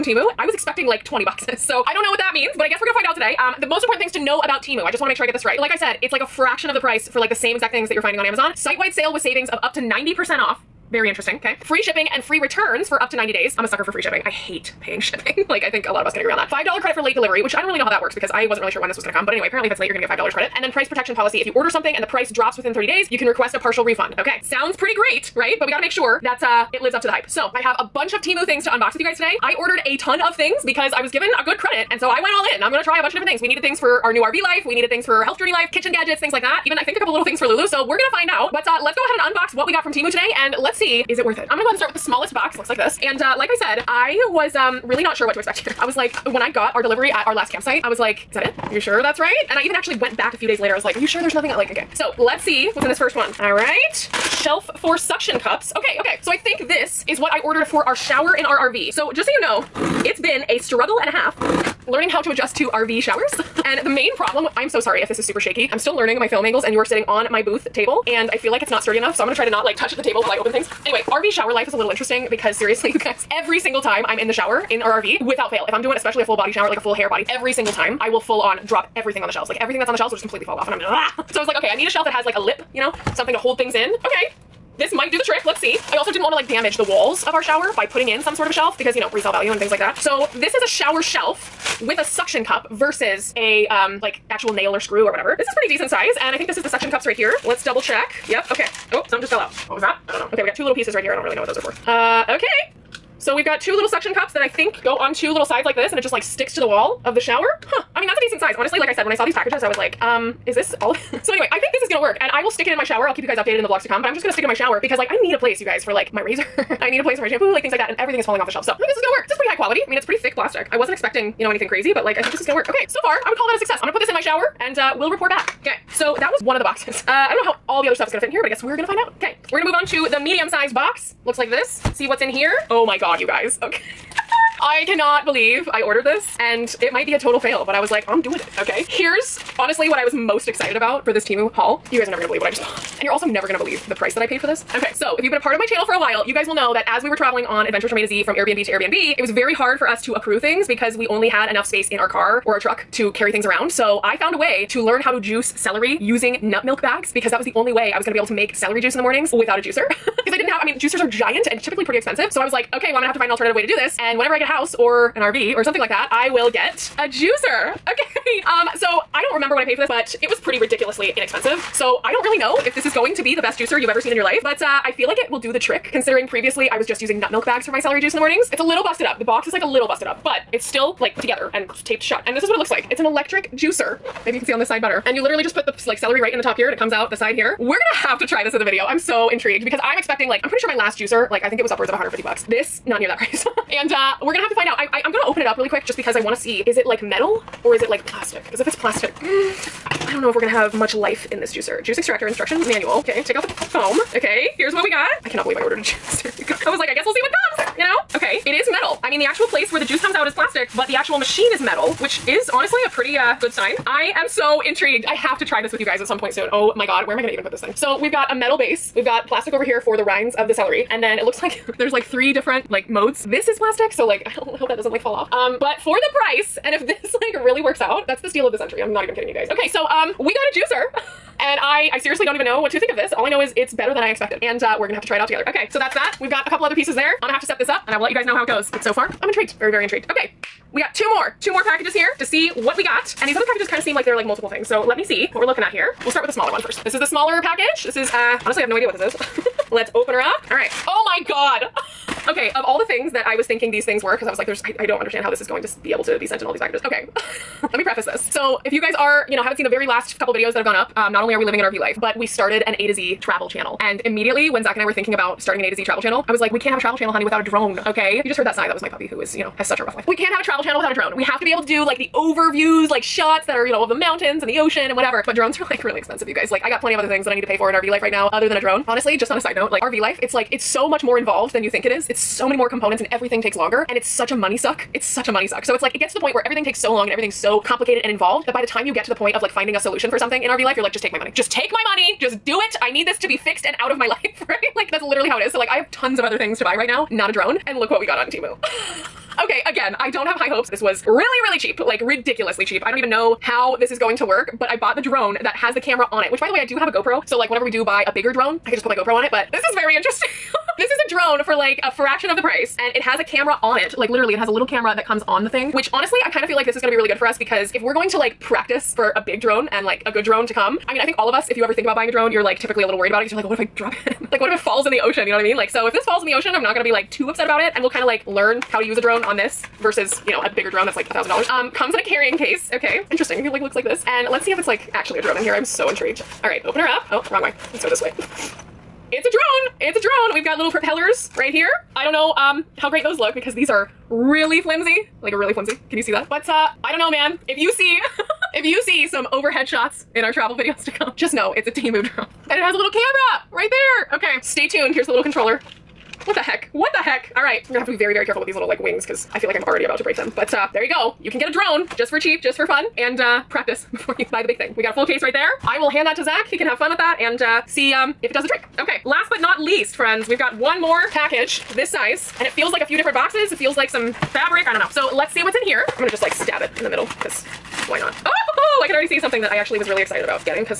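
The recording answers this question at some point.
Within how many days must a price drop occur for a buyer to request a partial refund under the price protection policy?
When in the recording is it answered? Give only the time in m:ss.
0:22.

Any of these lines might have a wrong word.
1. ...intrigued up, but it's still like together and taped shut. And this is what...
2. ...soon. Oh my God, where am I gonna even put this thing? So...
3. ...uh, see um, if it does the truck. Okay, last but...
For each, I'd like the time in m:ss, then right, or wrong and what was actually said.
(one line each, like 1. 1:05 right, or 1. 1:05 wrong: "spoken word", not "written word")
1. 2:59 wrong: "busted", not "intrigued"
2. 3:36 right
3. 6:07 wrong: "trick", not "truck".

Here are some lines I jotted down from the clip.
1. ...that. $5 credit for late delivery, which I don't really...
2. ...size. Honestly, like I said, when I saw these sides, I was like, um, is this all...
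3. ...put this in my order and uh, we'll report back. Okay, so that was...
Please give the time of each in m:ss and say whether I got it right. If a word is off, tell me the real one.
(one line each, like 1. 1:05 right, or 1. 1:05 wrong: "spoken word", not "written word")
1. 0:16 right
2. 1:48 wrong: "packages", not "sides"
3. 2:03 wrong: "shower", not "order".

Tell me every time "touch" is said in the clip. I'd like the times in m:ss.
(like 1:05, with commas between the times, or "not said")
1:09.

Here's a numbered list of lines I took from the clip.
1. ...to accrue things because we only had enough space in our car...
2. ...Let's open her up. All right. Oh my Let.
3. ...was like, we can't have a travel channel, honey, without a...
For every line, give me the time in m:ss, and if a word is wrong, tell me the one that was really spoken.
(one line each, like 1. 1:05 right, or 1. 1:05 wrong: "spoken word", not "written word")
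1. 2:30 right
2. 4:09 wrong: "God", not "Let"
3. 4:26 right.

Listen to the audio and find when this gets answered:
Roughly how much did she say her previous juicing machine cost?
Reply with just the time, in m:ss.
3:11.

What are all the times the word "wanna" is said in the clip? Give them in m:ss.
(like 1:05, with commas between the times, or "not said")
0:05, 1:26, 3:16.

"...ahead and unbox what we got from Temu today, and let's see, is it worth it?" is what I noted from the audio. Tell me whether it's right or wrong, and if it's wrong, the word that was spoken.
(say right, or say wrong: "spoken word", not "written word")
right.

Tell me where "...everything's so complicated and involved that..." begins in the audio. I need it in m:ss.
4:47.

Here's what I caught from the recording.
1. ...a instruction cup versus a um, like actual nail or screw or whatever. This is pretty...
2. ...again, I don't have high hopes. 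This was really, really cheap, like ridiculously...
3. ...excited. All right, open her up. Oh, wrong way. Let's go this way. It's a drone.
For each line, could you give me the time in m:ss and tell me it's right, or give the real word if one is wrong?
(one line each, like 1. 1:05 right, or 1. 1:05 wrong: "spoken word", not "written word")
1. 1:31 wrong: "suction", not "instruction"
2. 4:59 right
3. 5:35 wrong: "intrigued", not "excited".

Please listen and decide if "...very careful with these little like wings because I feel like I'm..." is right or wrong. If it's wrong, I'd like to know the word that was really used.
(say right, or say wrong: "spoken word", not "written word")
right.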